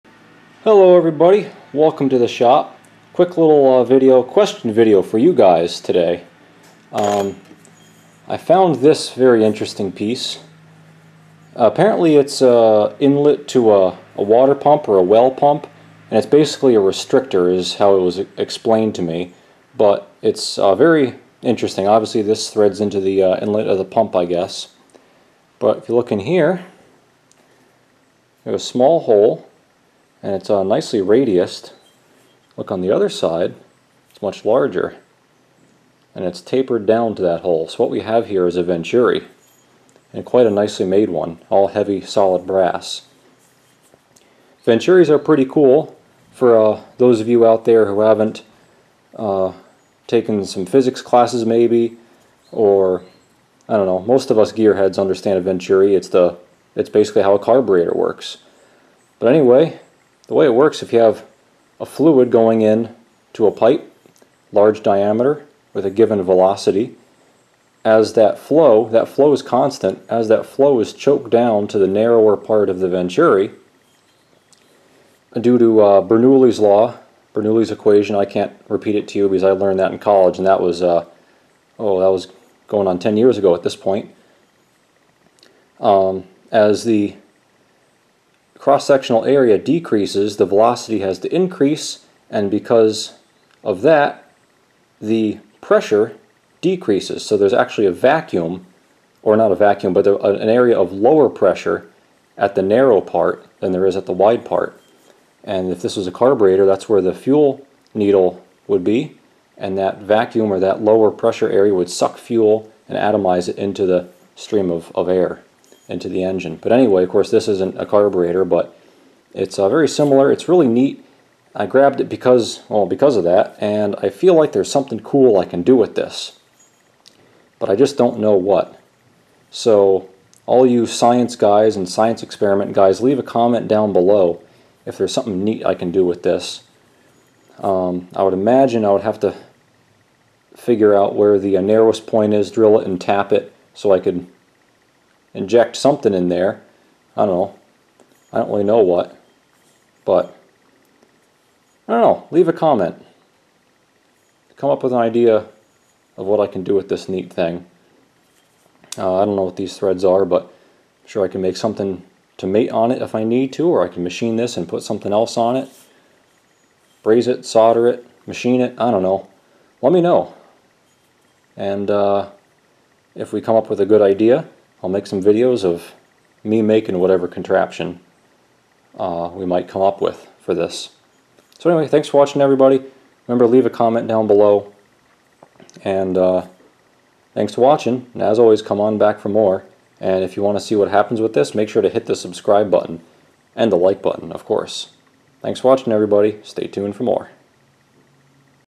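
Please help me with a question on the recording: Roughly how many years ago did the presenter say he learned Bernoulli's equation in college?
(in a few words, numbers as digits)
10.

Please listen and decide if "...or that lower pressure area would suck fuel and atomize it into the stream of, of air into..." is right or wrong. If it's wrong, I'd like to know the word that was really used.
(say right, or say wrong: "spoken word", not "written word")
right.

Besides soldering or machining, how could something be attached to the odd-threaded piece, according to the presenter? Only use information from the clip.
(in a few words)
braze.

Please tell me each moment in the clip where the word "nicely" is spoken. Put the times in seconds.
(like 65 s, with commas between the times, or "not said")
30 s, 40 s.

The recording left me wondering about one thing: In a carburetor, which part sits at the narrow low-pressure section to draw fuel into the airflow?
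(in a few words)
fuel needle.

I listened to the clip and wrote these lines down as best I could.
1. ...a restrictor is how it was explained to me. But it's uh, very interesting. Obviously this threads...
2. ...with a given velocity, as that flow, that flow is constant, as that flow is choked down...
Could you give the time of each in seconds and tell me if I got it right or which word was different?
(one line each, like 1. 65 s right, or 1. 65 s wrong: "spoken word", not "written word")
1. 16 s right
2. 65 s right.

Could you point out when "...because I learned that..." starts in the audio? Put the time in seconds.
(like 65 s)
79 s.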